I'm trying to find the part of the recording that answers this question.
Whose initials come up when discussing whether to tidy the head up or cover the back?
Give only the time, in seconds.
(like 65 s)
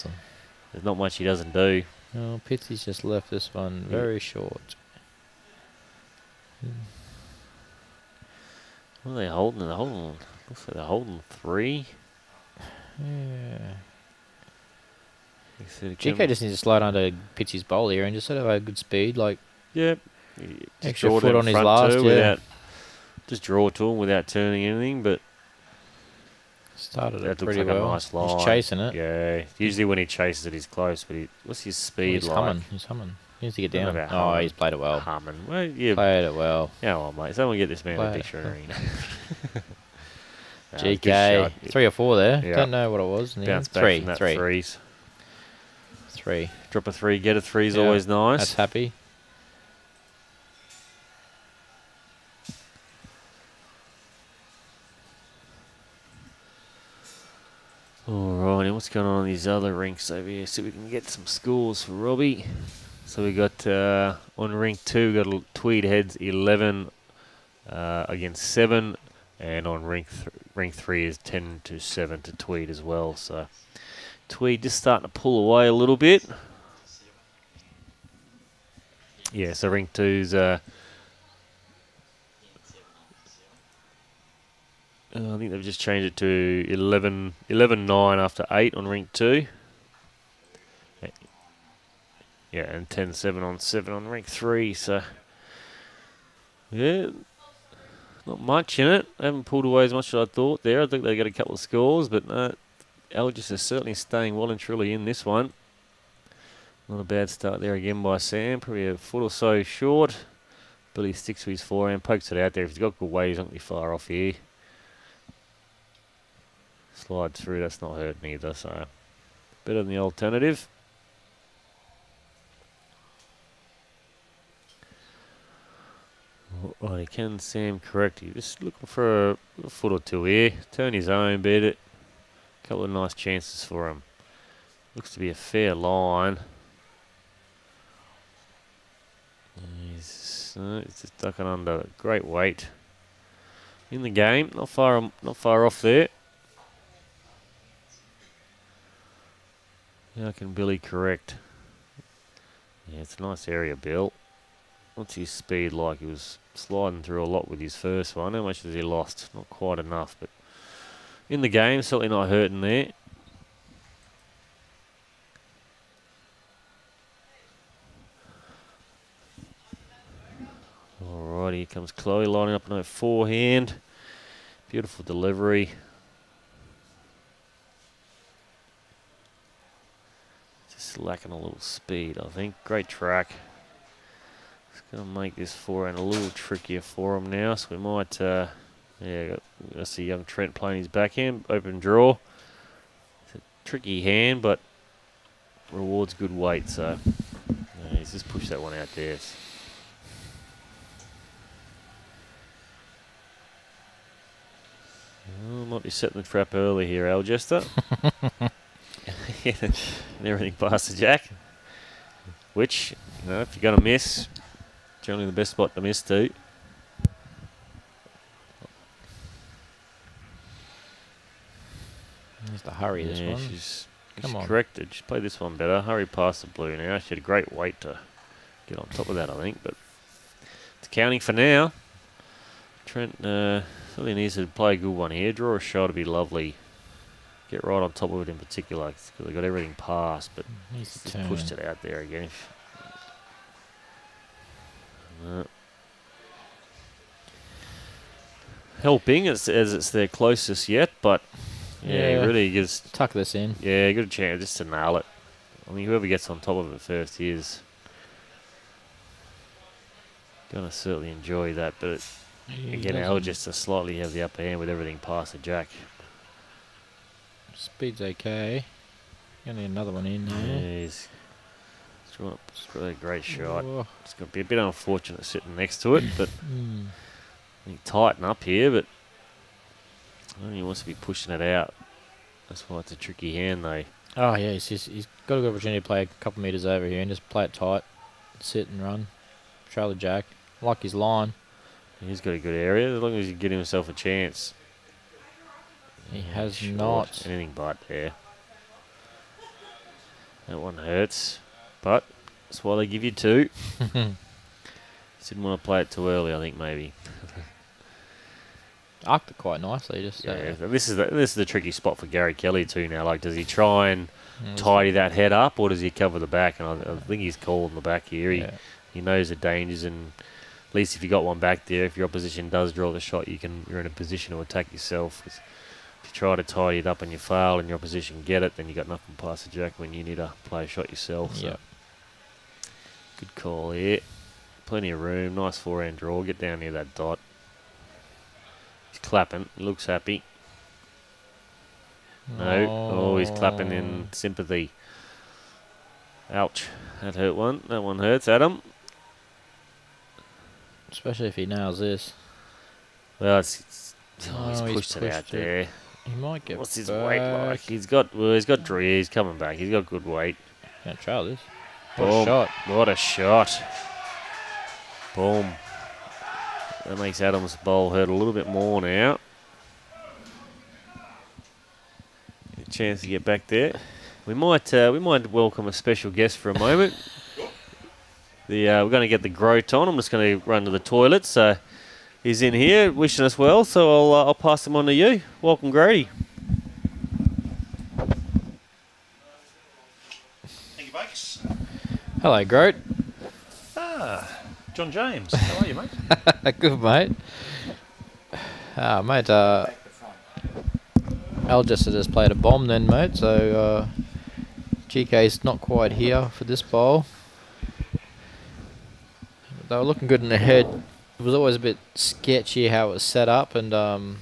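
312 s.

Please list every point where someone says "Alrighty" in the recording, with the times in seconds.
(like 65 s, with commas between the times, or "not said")
58 s, 171 s.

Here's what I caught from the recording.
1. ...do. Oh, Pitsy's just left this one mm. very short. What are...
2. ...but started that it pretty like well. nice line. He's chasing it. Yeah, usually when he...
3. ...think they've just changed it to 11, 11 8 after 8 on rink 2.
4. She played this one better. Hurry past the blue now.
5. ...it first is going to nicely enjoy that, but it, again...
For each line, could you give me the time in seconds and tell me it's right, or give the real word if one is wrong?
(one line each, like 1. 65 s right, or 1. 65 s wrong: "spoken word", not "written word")
1. 1 s right
2. 25 s right
3. 85 s wrong: "9", not "8"
4. 224 s right
5. 256 s wrong: "certainly", not "nicely".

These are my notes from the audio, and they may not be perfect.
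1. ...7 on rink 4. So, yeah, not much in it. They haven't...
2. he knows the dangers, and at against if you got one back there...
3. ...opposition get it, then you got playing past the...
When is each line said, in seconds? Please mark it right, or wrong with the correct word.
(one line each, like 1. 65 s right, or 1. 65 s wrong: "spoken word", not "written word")
1. 93 s wrong: "3", not "4"
2. 318 s wrong: "least", not "against"
3. 327 s wrong: "nothing", not "playing".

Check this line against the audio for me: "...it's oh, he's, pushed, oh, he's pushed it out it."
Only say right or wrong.
right.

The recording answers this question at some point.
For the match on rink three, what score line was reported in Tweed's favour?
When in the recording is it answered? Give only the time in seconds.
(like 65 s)
71 s.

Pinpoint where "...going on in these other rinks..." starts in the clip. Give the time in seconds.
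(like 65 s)
58 s.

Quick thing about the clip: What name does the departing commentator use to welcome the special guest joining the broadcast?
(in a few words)
Grady.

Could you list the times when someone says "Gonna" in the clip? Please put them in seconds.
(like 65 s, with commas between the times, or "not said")
184 s, 269 s.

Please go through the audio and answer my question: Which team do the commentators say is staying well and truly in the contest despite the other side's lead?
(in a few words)
Algis.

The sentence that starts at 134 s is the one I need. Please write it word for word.
Looks to be a fair line.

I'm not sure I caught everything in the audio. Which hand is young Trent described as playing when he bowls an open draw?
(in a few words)
backhand.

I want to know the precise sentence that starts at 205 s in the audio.
Oh, might be setting the trap early here, Algester.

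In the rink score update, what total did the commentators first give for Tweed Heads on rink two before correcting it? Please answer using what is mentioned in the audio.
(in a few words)
11.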